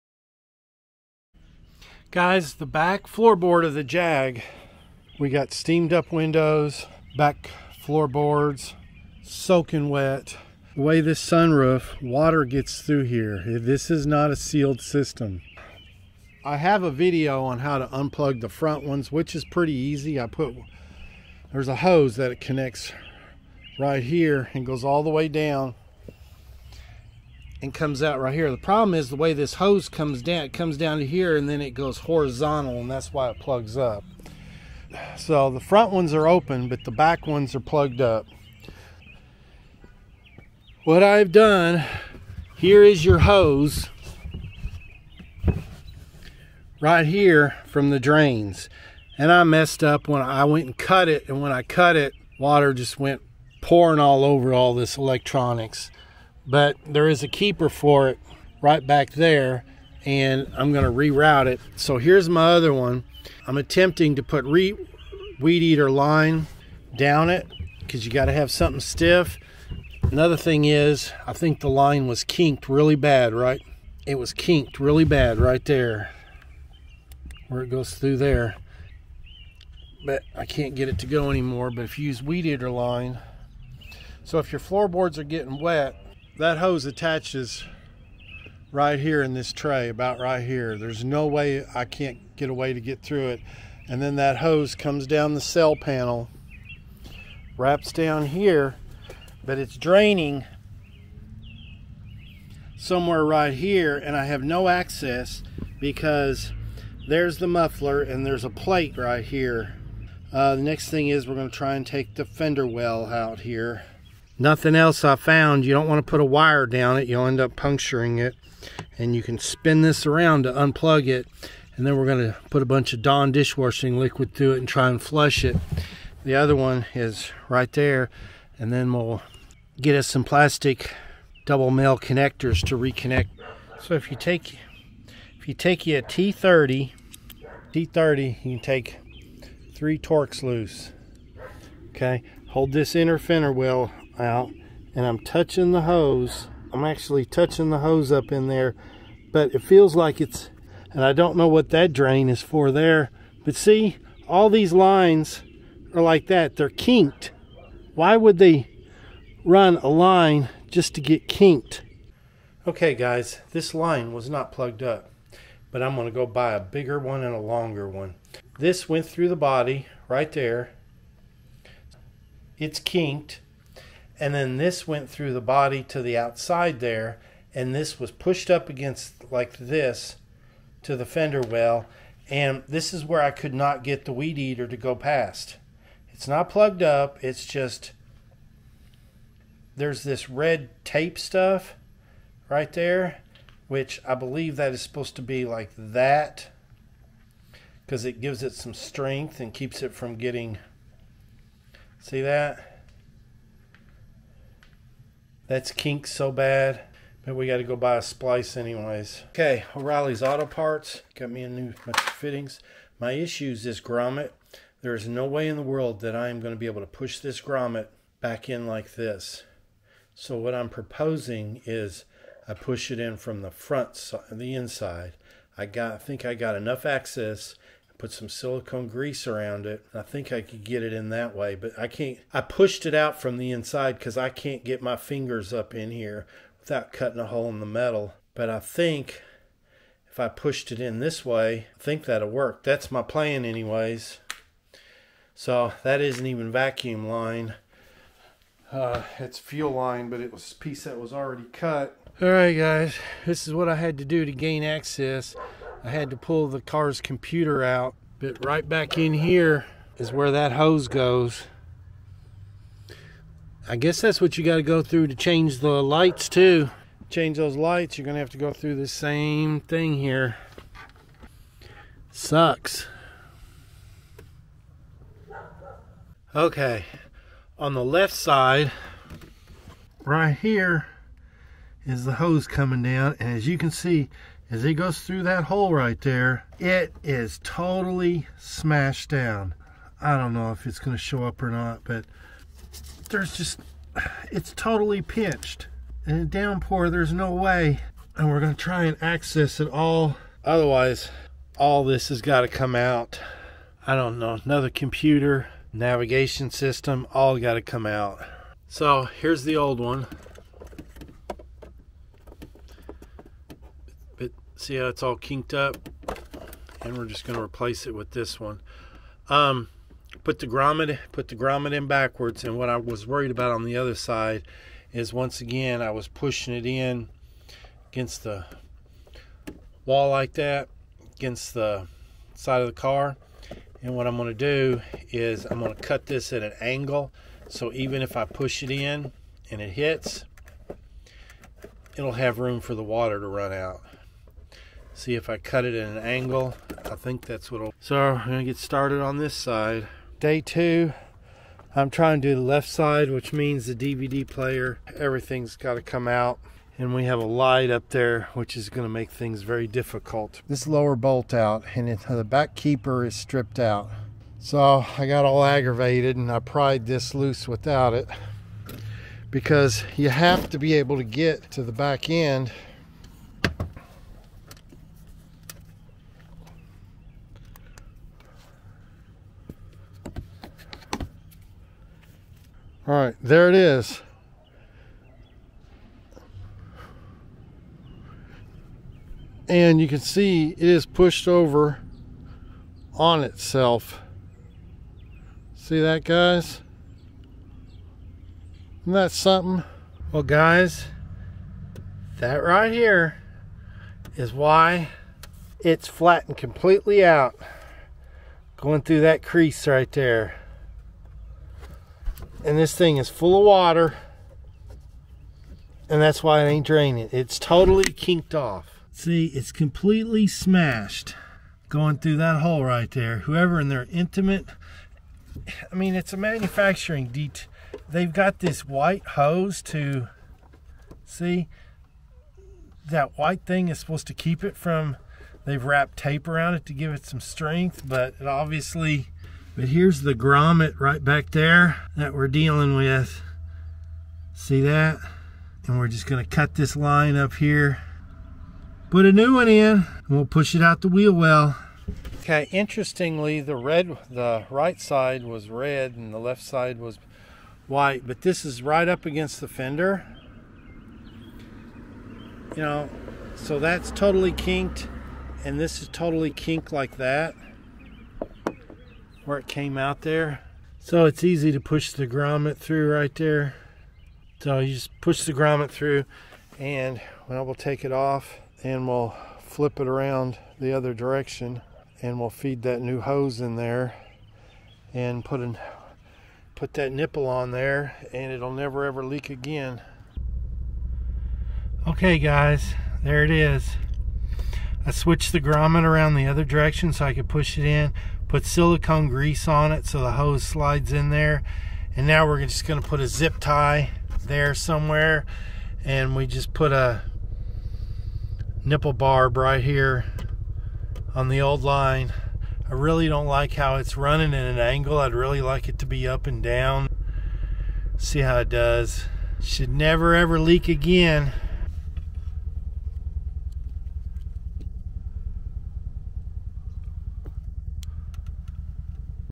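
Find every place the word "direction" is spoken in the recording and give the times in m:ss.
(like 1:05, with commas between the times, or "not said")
8:00, 8:16.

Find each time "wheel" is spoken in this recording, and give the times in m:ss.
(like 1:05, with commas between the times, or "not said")
2:23, 7:30.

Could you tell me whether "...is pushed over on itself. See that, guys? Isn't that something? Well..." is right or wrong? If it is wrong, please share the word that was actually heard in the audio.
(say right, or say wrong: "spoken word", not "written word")
right.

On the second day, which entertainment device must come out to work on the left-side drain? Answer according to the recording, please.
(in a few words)
DVD player.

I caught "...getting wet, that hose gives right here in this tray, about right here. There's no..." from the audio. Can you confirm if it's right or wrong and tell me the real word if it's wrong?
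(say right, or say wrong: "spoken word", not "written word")
wrong: "attaches", not "gives".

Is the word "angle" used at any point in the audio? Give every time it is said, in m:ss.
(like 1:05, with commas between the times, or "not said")
5:36, 5:45, 8:34.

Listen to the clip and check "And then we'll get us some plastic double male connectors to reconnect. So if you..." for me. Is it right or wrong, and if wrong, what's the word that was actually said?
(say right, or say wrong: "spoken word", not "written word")
right.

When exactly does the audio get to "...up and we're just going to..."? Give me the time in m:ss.
5:15.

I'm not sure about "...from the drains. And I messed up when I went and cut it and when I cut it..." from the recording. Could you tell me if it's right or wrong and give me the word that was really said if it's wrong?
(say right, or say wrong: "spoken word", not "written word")
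right.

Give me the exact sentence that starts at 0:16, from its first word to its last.
I have a video on how to unplug the front ones, which is pretty easy.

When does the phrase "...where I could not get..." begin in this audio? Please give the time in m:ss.
3:03.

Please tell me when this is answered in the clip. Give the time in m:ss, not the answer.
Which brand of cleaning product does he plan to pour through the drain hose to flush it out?
2:03.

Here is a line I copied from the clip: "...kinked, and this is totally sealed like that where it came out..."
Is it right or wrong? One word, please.
wrong.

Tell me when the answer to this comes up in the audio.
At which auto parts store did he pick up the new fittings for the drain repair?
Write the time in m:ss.
3:29.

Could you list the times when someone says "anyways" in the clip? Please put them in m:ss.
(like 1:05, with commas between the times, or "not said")
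3:28, 4:03.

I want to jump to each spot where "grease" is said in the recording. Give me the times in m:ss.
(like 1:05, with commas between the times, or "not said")
3:48, 8:19.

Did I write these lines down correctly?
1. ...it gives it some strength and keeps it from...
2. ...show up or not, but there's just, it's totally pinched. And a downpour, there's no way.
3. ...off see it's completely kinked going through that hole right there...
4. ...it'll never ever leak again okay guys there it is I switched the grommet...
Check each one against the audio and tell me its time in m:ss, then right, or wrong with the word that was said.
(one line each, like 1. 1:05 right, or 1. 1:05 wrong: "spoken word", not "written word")
1. 3:18 right
2. 4:51 right
3. 6:58 wrong: "smashed", not "kinked"
4. 8:08 right.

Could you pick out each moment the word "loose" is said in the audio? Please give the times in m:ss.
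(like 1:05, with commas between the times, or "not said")
2:20, 6:07.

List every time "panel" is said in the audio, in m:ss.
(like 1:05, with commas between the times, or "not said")
1:35.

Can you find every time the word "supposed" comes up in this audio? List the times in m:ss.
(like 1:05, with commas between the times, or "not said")
3:14, 7:13.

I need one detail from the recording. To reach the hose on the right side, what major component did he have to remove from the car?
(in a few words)
The car's computer.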